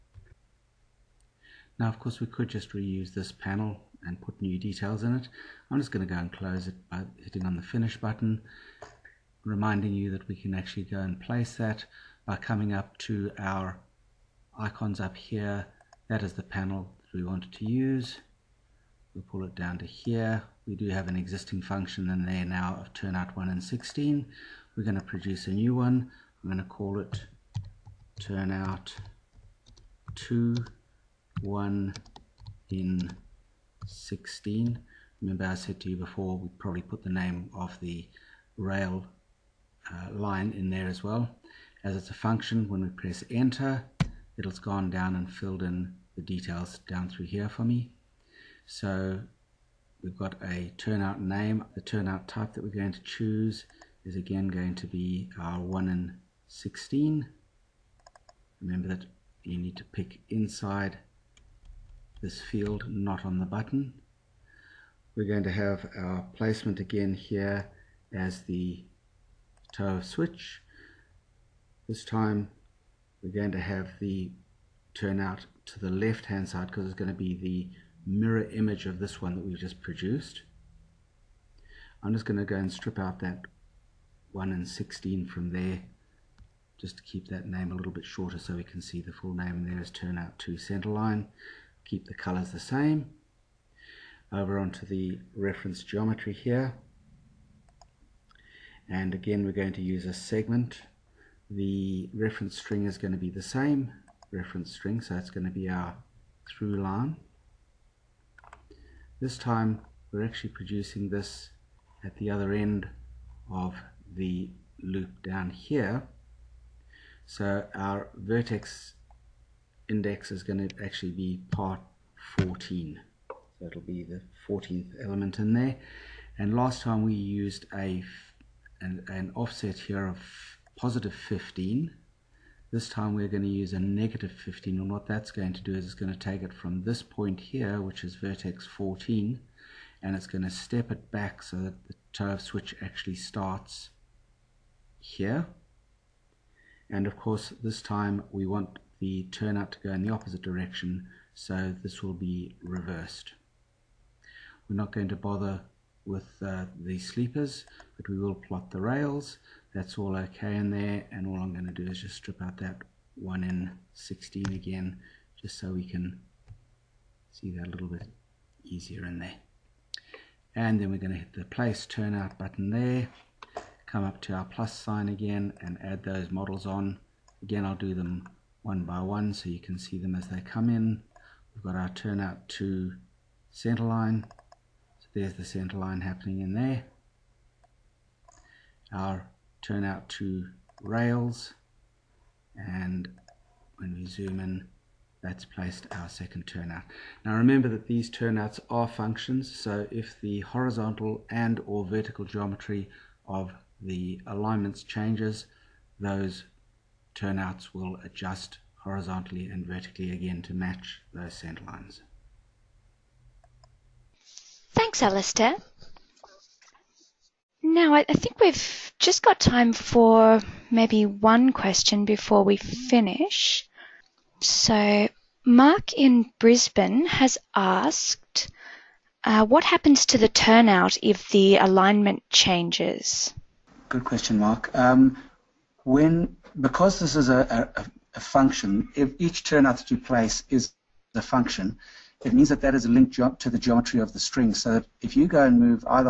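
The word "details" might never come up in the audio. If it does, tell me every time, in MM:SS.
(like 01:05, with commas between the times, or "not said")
00:04, 00:46.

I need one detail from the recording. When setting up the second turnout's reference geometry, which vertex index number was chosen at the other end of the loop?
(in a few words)
14.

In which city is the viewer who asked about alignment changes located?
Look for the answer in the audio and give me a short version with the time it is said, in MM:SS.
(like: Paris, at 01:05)
Brisbane, at 03:46.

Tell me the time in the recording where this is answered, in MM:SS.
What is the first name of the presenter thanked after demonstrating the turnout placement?
03:35.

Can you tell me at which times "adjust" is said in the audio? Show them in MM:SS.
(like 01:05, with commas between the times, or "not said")
03:28.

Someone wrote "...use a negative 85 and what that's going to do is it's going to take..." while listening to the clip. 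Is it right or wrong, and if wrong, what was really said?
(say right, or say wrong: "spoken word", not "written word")
wrong: "15", not "85".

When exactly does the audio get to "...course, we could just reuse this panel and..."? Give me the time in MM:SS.
00:01.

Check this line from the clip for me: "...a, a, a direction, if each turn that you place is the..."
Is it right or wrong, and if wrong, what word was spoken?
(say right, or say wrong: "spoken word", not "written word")
wrong: "function", not "direction".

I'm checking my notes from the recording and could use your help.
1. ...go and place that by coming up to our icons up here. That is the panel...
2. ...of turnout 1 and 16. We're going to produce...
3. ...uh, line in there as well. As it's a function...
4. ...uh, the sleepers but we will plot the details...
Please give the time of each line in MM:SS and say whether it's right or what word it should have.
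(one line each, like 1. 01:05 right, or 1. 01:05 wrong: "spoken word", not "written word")
1. 00:10 right
2. 00:22 right
3. 00:39 right
4. 02:36 wrong: "rails", not "details".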